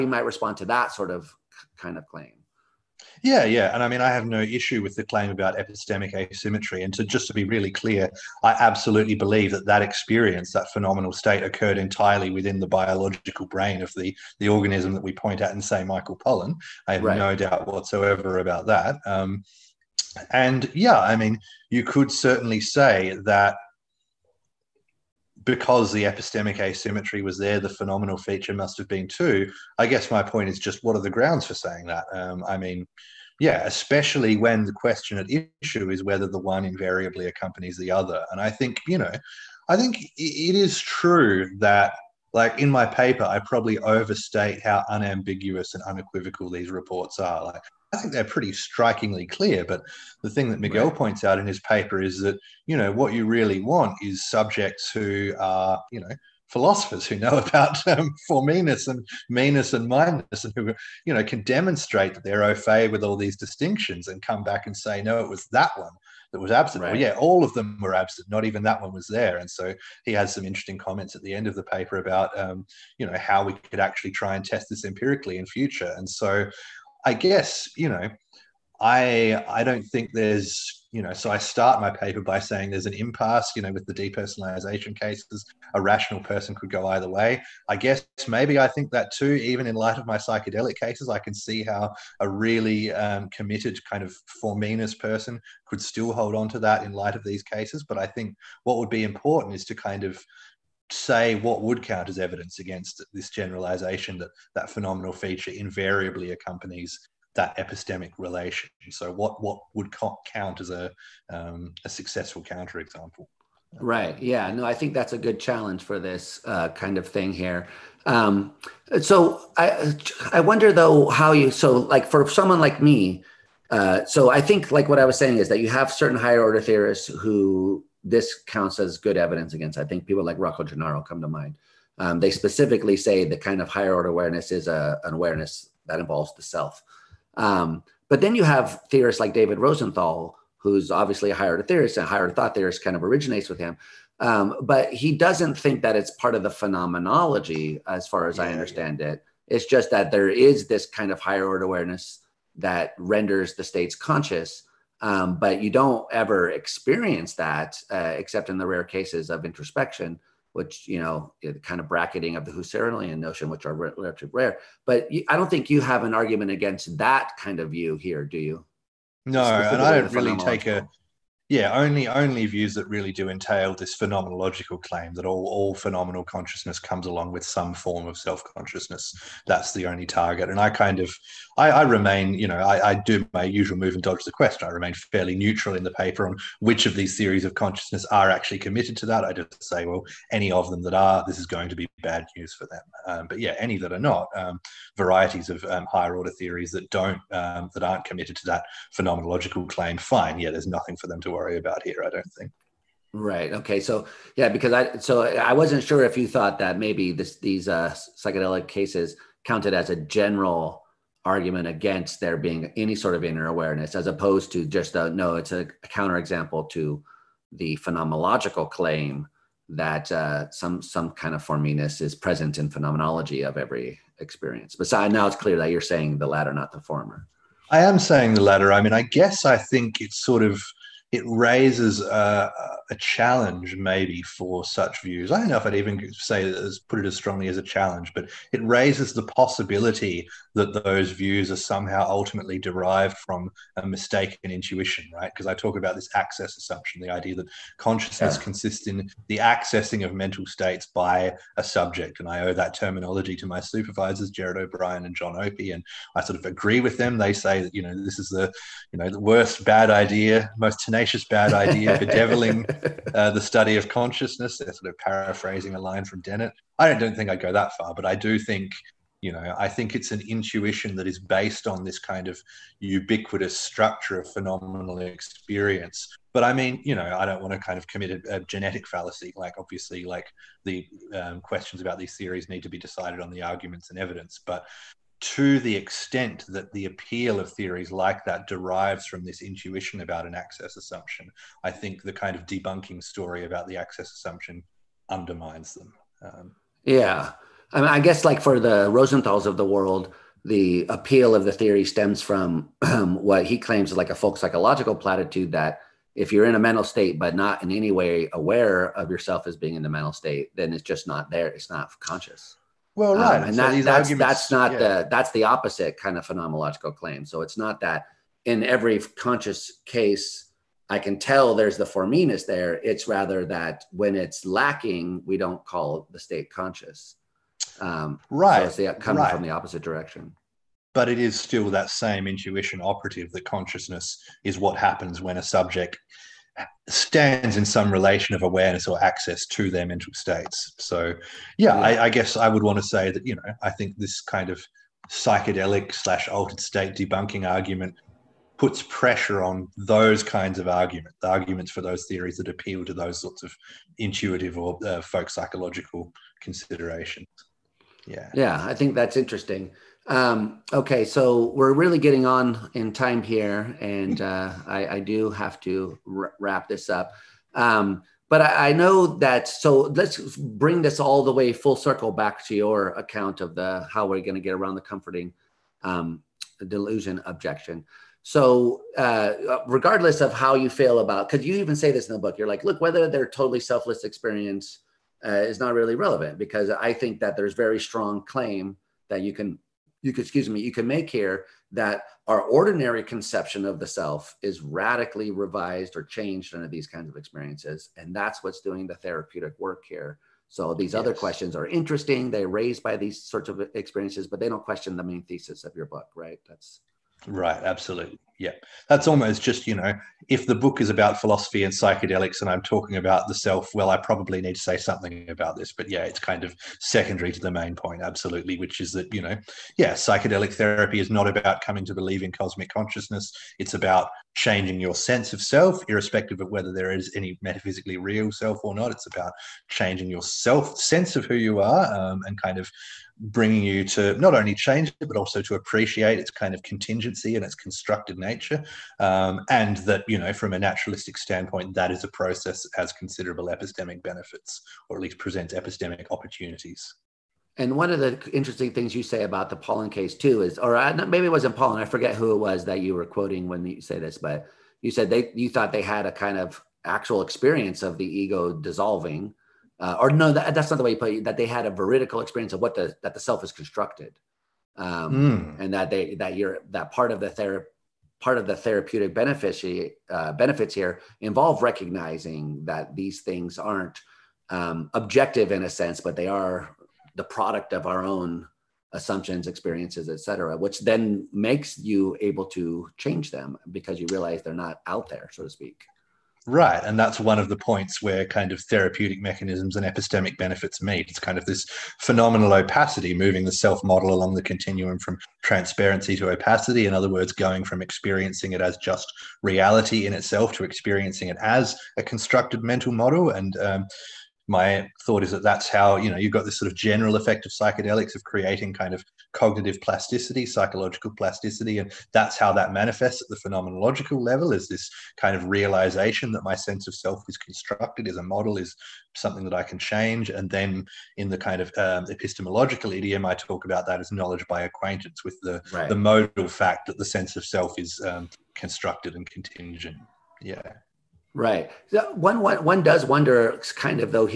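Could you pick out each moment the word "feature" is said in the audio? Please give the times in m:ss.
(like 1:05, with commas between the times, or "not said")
0:28, 1:45.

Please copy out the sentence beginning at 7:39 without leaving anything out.
Uh, or no, that, that's not the way you put it.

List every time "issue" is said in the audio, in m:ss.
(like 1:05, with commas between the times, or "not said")
0:04, 0:35.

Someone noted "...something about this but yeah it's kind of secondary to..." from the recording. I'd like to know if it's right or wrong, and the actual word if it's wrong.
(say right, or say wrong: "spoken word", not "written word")
right.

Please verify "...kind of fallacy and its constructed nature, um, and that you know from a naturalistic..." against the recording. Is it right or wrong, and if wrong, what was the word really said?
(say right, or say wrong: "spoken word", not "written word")
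wrong: "contingency", not "fallacy".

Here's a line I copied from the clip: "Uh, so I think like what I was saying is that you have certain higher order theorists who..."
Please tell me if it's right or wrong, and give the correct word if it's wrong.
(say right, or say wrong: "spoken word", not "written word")
right.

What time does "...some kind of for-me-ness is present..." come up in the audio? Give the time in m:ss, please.
3:40.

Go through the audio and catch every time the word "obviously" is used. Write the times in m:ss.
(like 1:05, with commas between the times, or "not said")
2:20, 4:39.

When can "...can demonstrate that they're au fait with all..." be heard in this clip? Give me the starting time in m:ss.
1:01.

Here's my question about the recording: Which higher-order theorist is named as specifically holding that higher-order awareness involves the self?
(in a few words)
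Rocco Gennaro.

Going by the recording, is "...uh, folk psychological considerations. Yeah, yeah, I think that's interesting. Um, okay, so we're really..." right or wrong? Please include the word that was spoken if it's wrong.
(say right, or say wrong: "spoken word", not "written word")
right.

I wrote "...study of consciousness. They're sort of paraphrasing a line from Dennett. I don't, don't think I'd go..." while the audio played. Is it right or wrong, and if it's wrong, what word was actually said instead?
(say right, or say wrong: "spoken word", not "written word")
right.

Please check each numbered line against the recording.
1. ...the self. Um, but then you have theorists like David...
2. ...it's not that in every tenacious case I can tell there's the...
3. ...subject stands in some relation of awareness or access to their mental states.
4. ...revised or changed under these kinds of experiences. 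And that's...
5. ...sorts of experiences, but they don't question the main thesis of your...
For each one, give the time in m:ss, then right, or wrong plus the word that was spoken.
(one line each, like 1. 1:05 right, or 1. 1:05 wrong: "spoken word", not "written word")
1. 2:16 right
2. 5:17 wrong: "conscious", not "tenacious"
3. 5:35 right
4. 6:35 right
5. 6:43 right.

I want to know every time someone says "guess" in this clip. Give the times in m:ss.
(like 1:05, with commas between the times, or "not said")
0:29, 1:17, 1:27, 3:49, 4:58, 5:42.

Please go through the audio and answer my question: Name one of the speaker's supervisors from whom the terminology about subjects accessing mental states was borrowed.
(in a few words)
Gerard O'Brien.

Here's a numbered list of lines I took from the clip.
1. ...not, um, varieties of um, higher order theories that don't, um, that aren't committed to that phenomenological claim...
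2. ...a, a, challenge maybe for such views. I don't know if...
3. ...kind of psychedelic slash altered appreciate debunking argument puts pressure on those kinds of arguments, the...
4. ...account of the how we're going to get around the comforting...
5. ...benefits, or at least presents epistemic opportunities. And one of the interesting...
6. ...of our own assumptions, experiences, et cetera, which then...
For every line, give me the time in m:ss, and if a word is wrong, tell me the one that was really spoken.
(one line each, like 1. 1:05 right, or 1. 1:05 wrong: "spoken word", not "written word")
1. 3:14 right
2. 3:52 right
3. 5:44 wrong: "state", not "appreciate"
4. 6:12 right
5. 7:24 right
6. 7:57 right.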